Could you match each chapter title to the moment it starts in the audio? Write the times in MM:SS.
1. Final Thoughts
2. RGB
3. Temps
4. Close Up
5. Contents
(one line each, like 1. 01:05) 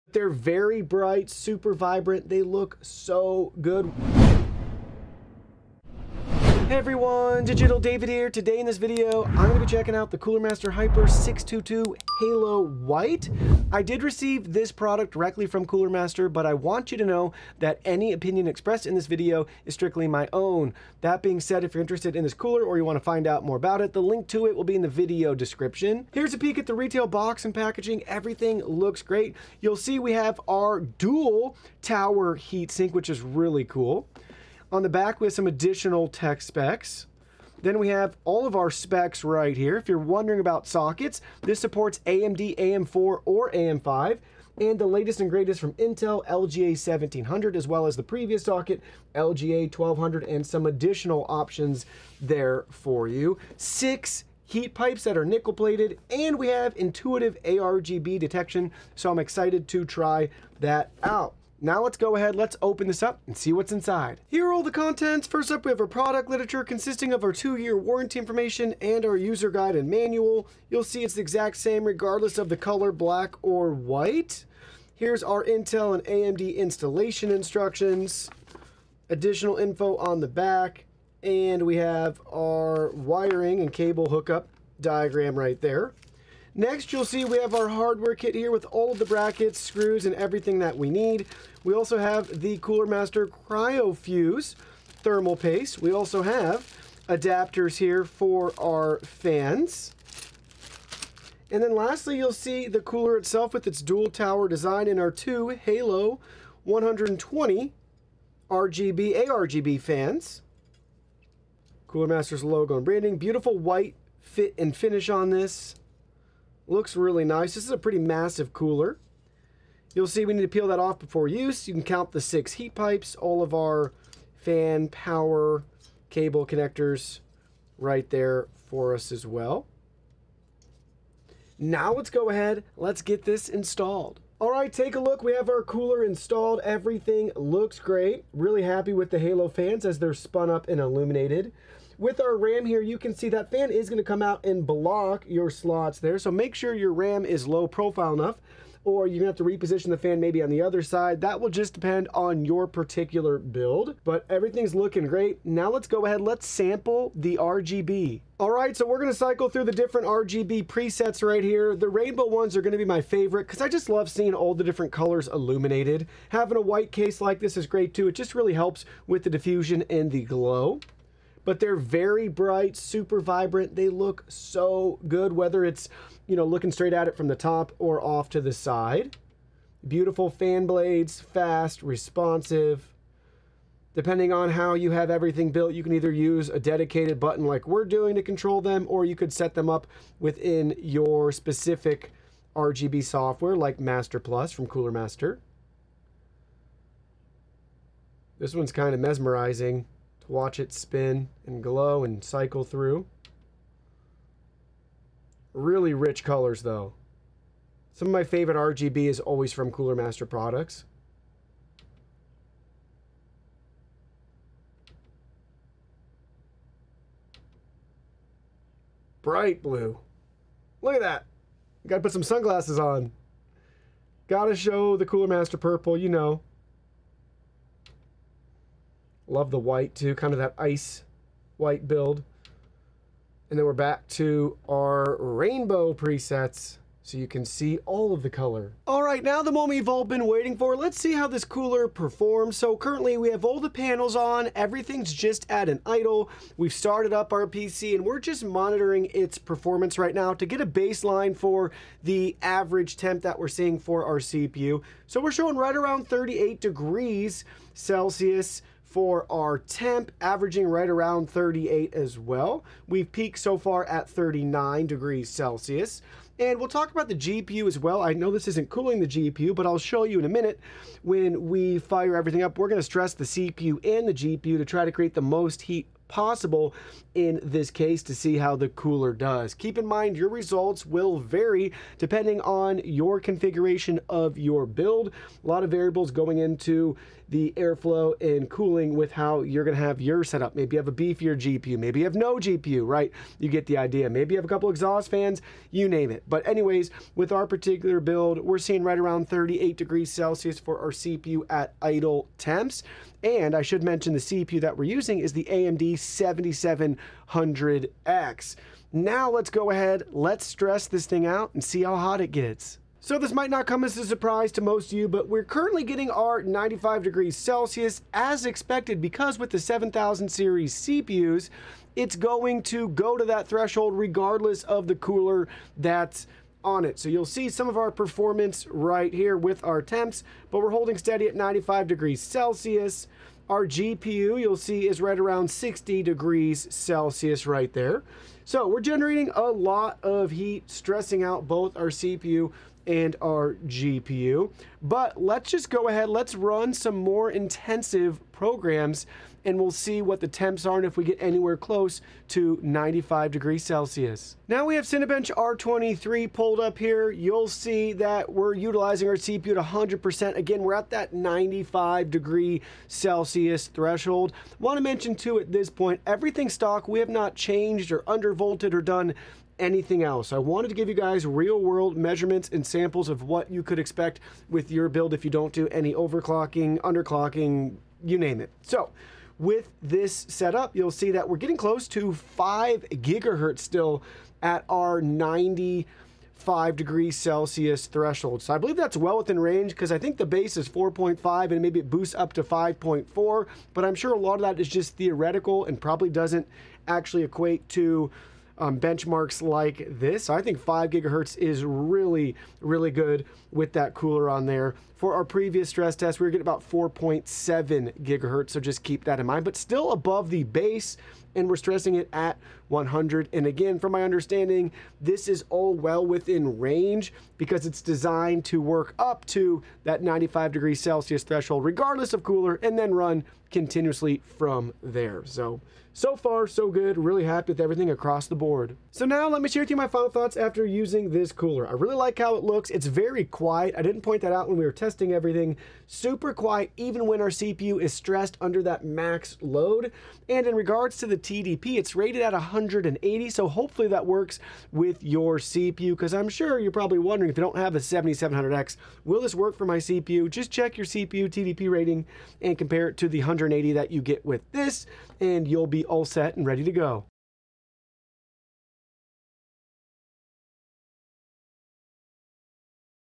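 1. 07:08
2. 02:38
3. 03:59
4. 02:14
5. 01:04.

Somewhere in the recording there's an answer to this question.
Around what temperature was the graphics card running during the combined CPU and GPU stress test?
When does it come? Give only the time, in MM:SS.
05:35.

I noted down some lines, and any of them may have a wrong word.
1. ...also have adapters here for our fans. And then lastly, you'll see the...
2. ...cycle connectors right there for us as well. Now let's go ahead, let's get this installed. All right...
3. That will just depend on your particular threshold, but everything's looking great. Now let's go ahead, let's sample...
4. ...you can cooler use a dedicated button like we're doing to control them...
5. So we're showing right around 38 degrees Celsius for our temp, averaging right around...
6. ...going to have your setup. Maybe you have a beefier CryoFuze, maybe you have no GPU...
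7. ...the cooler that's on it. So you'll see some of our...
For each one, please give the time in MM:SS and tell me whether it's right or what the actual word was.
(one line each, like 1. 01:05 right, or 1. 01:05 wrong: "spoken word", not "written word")
1. 01:35 right
2. 02:06 wrong: "cable", not "cycle"
3. 02:31 wrong: "build", not "threshold"
4. 03:05 wrong: "either", not "cooler"
5. 04:15 right
6. 04:49 wrong: "GPU", not "CryoFuze"
7. 05:24 right.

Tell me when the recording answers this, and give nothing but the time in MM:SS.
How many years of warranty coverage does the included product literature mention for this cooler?
01:07.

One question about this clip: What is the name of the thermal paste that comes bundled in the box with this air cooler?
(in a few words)
CryoFuze.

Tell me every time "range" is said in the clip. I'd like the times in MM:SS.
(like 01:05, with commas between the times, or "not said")
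06:29, 06:56.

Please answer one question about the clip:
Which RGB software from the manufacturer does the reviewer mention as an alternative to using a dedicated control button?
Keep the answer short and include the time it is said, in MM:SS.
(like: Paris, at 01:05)
Master Plus, at 03:13.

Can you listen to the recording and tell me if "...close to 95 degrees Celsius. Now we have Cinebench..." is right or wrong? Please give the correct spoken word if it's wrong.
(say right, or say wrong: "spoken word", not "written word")
right.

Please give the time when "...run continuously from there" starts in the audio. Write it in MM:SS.
07:02.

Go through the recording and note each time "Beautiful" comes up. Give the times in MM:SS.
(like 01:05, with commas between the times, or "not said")
01:53, 02:59.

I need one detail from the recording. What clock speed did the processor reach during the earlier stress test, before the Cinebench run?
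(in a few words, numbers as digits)
4.7 GHz.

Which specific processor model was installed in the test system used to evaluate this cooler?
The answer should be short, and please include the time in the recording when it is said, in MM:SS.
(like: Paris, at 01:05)
AMD 7700X, at 05:05.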